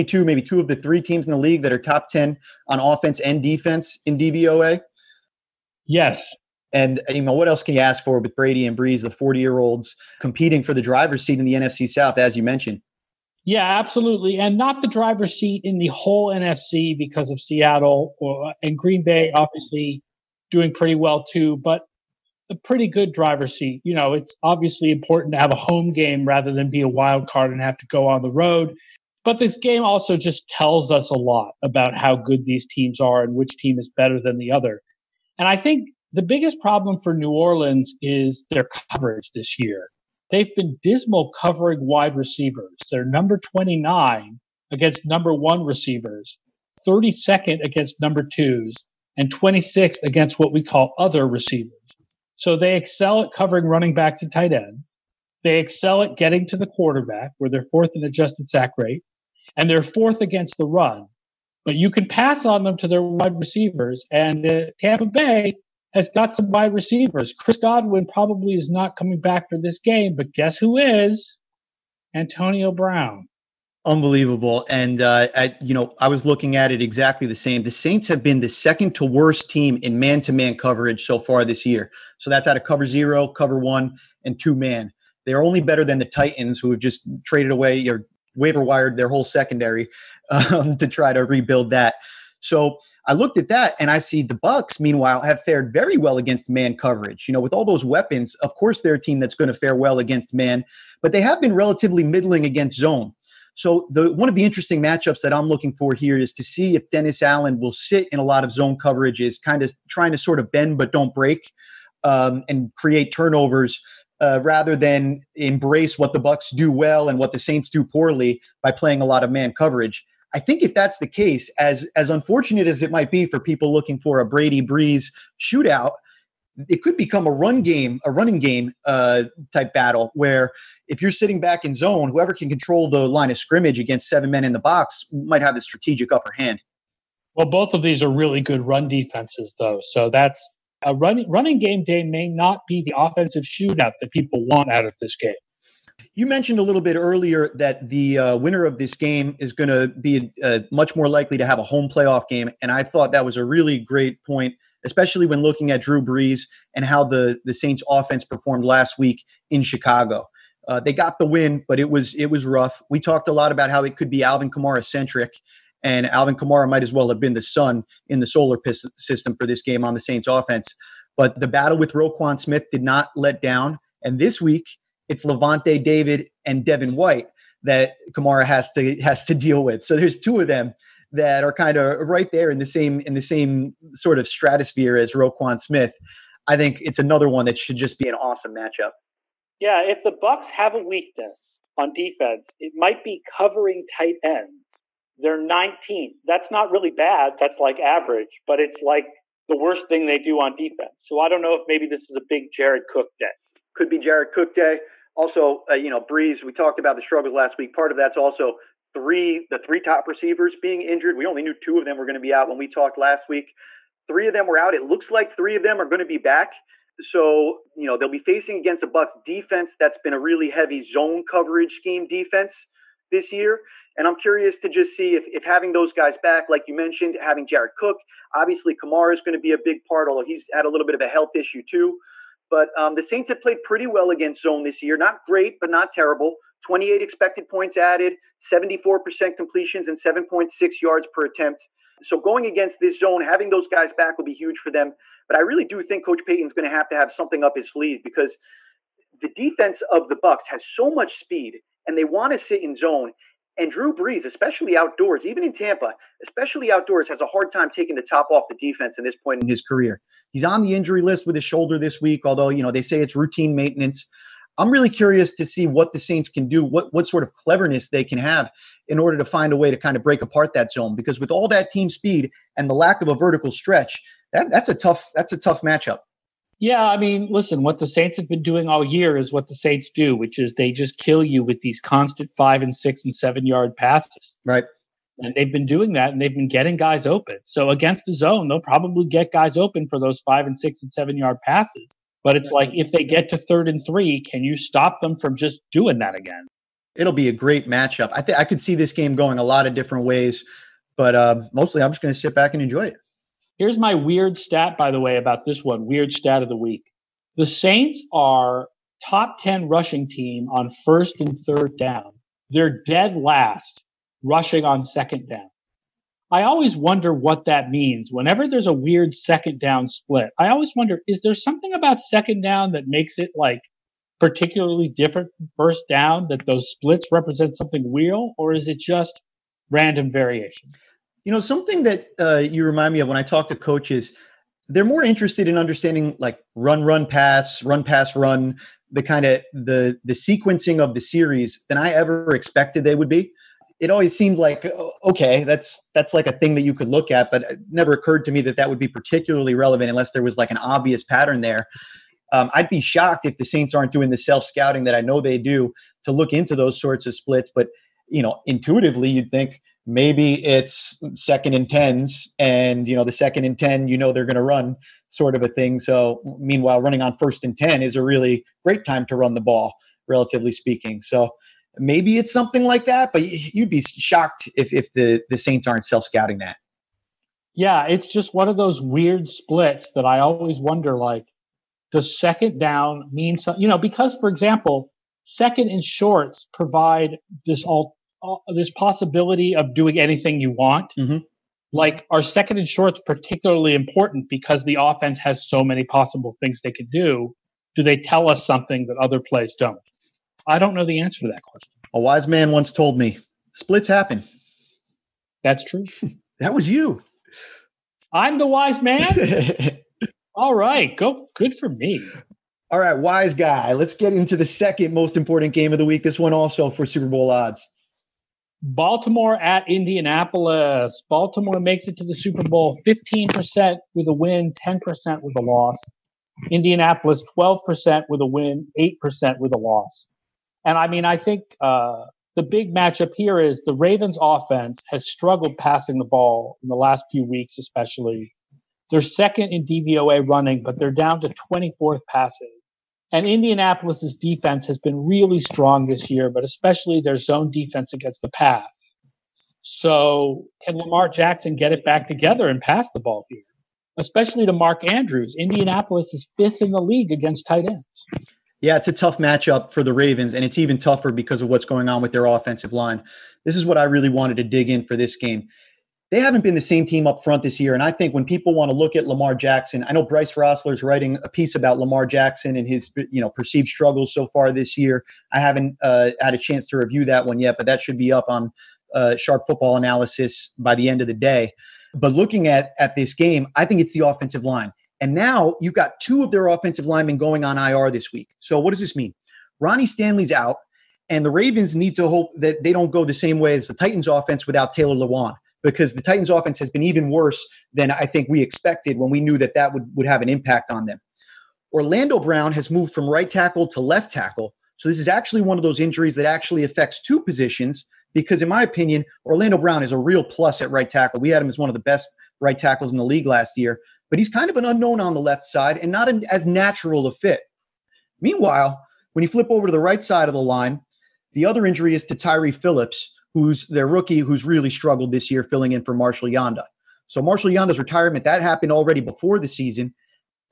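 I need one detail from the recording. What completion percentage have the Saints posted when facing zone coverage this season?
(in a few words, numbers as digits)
74%.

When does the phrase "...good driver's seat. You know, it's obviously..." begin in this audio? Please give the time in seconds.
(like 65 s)
22 s.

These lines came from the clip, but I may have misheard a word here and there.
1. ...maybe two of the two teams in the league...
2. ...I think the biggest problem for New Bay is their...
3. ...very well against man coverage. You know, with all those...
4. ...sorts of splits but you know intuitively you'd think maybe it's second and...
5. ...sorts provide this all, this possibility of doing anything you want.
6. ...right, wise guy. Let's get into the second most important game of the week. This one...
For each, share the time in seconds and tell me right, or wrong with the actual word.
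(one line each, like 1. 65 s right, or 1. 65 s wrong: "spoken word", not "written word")
1. 0 s wrong: "three", not "two"
2. 35 s wrong: "Orleans", not "Bay"
3. 95 s right
4. 356 s right
5. 385 s wrong: "shorts", not "sorts"
6. 412 s right.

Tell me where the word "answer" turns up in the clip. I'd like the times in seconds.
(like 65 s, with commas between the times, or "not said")
401 s.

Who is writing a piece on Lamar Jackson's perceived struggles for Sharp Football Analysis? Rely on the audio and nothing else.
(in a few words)
Bryce Rossler.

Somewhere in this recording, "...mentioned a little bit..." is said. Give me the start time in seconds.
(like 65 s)
146 s.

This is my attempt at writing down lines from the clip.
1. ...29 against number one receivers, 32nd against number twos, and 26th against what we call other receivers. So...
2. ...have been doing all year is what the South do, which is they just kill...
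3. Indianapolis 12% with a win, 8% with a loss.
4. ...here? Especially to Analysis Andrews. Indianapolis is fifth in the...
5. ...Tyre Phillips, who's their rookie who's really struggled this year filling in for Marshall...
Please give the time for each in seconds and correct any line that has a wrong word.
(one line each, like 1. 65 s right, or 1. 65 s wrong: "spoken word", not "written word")
1. 43 s right
2. 278 s wrong: "Saints", not "South"
3. 426 s right
4. 453 s wrong: "Mark", not "Analysis"
5. 522 s right.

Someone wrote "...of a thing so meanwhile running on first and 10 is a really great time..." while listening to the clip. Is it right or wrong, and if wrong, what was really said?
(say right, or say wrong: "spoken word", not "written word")
right.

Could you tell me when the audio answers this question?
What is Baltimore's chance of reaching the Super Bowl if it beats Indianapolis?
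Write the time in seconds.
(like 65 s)
422 s.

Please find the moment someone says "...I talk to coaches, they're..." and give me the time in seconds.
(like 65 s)
333 s.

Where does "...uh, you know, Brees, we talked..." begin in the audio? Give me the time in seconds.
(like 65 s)
205 s.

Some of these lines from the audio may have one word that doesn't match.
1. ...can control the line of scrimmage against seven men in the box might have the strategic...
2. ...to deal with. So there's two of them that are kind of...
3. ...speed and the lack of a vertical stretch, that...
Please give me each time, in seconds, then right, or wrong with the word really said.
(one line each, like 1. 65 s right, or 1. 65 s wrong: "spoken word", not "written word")
1. 132 s right
2. 179 s right
3. 271 s right.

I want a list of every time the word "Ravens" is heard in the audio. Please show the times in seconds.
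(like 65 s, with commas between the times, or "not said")
433 s, 459 s, 491 s.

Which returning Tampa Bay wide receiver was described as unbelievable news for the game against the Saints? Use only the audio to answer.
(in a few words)
Antonio Brown.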